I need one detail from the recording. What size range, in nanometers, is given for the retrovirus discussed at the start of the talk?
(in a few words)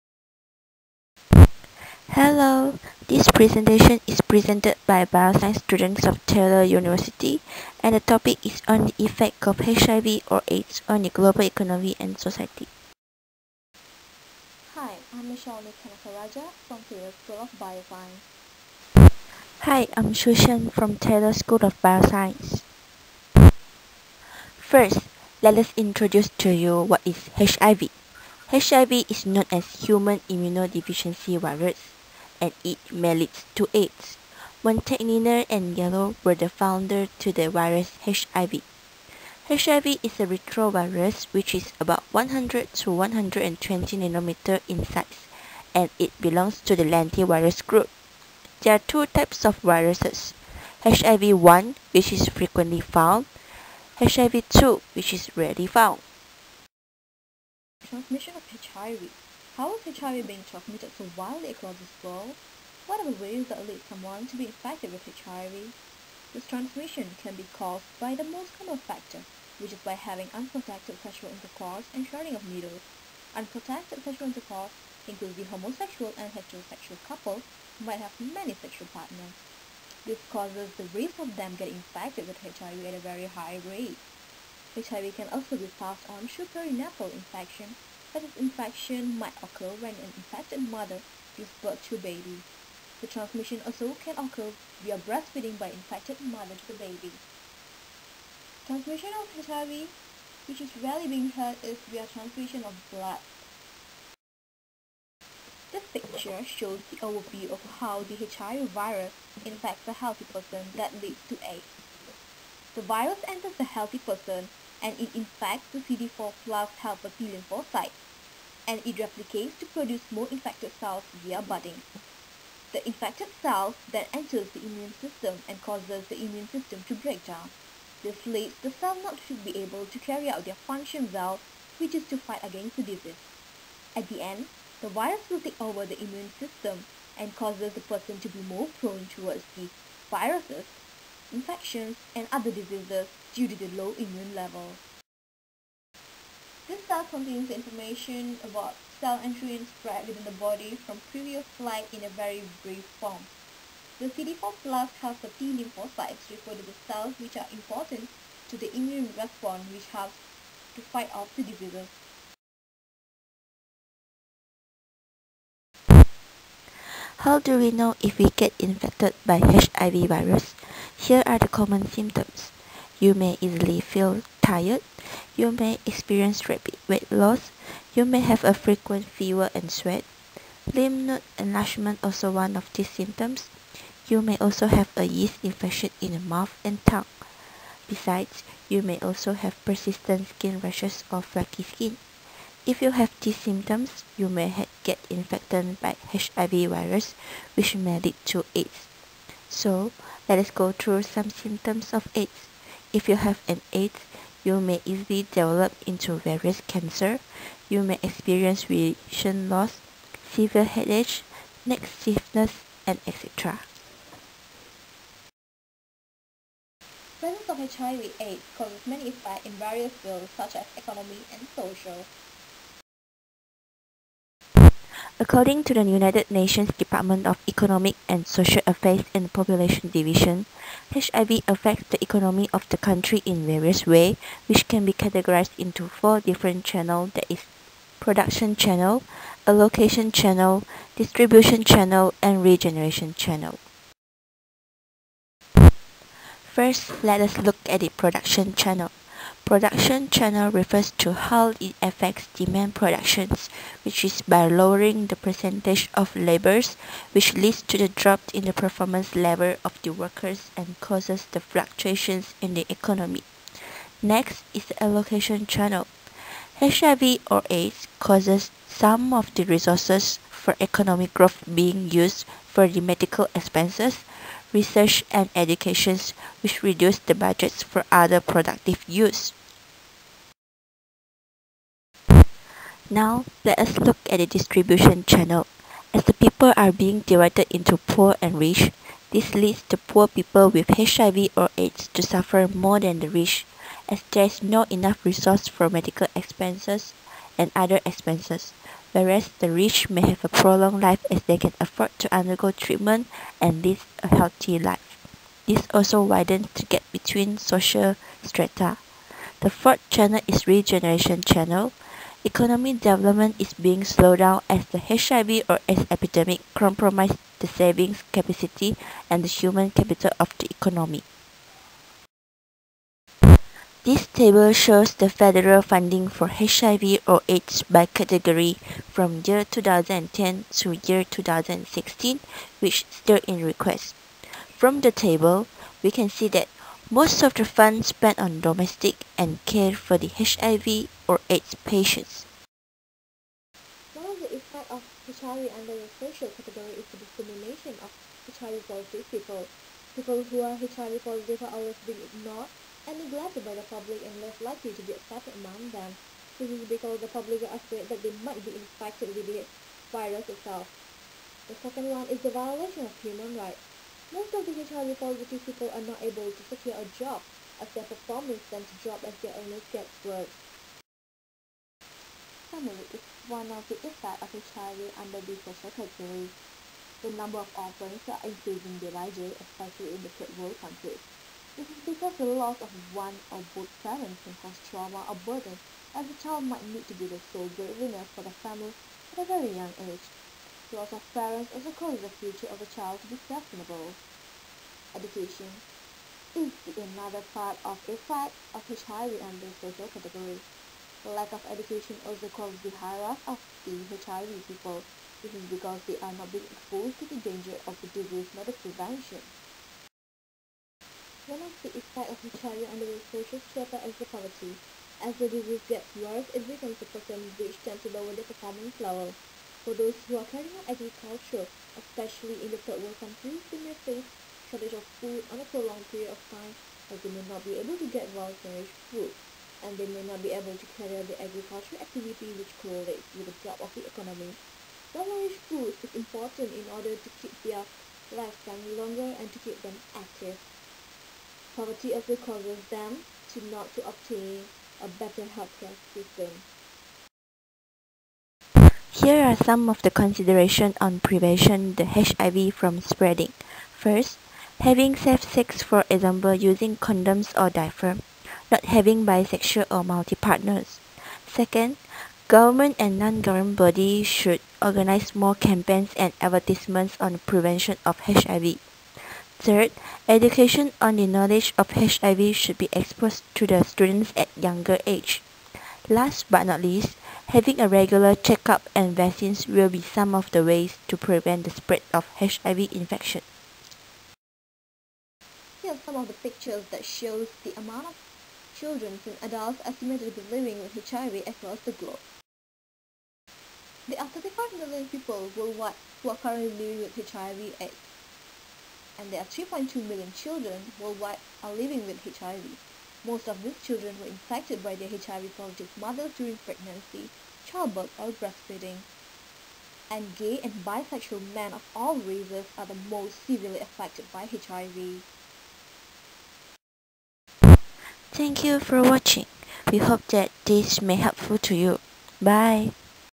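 100 to 120 nanometers.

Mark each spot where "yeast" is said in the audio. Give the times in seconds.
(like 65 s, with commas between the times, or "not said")
185 s.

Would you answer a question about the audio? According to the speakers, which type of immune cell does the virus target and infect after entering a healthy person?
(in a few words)
CD4 plus helper T lymphocyte.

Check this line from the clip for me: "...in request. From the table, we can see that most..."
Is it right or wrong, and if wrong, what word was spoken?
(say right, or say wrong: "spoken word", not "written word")
right.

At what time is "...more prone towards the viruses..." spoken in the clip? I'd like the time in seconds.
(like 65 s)
138 s.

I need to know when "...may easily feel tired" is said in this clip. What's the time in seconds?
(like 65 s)
173 s.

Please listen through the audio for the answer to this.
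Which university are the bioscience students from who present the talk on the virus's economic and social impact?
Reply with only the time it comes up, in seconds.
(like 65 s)
6 s.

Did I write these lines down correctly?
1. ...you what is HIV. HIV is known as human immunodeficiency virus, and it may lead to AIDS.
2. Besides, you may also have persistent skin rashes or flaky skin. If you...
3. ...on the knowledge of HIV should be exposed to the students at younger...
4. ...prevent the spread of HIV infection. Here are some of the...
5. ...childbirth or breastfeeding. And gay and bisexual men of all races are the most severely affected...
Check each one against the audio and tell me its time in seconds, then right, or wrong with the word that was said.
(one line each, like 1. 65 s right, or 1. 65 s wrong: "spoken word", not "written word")
1. 26 s right
2. 187 s right
3. 470 s right
4. 480 s right
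5. 507 s right.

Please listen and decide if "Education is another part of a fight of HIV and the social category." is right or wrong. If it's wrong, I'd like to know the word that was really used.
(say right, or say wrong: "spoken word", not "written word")
right.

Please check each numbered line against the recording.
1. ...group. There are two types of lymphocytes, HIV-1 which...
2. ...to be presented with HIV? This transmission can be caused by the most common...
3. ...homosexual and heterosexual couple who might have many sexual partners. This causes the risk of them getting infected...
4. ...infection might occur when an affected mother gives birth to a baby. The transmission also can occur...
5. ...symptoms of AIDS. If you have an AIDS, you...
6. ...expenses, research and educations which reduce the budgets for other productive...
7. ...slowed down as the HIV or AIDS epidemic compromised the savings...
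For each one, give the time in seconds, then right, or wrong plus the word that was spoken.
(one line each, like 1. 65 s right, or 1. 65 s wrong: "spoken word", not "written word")
1. 47 s wrong: "viruses", not "lymphocytes"
2. 64 s wrong: "infected", not "presented"
3. 75 s right
4. 88 s wrong: "infected", not "affected"
5. 201 s right
6. 273 s right
7. 313 s right.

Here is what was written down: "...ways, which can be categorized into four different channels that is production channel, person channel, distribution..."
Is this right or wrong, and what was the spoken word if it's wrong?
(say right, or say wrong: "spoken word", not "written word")
wrong: "allocation", not "person".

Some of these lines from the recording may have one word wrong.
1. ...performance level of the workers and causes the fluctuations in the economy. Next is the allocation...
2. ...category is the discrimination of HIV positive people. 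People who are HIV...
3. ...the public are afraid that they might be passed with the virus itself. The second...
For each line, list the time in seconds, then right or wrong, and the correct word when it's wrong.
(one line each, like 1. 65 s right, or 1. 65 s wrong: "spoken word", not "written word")
1. 258 s right
2. 346 s right
3. 356 s wrong: "infected", not "passed".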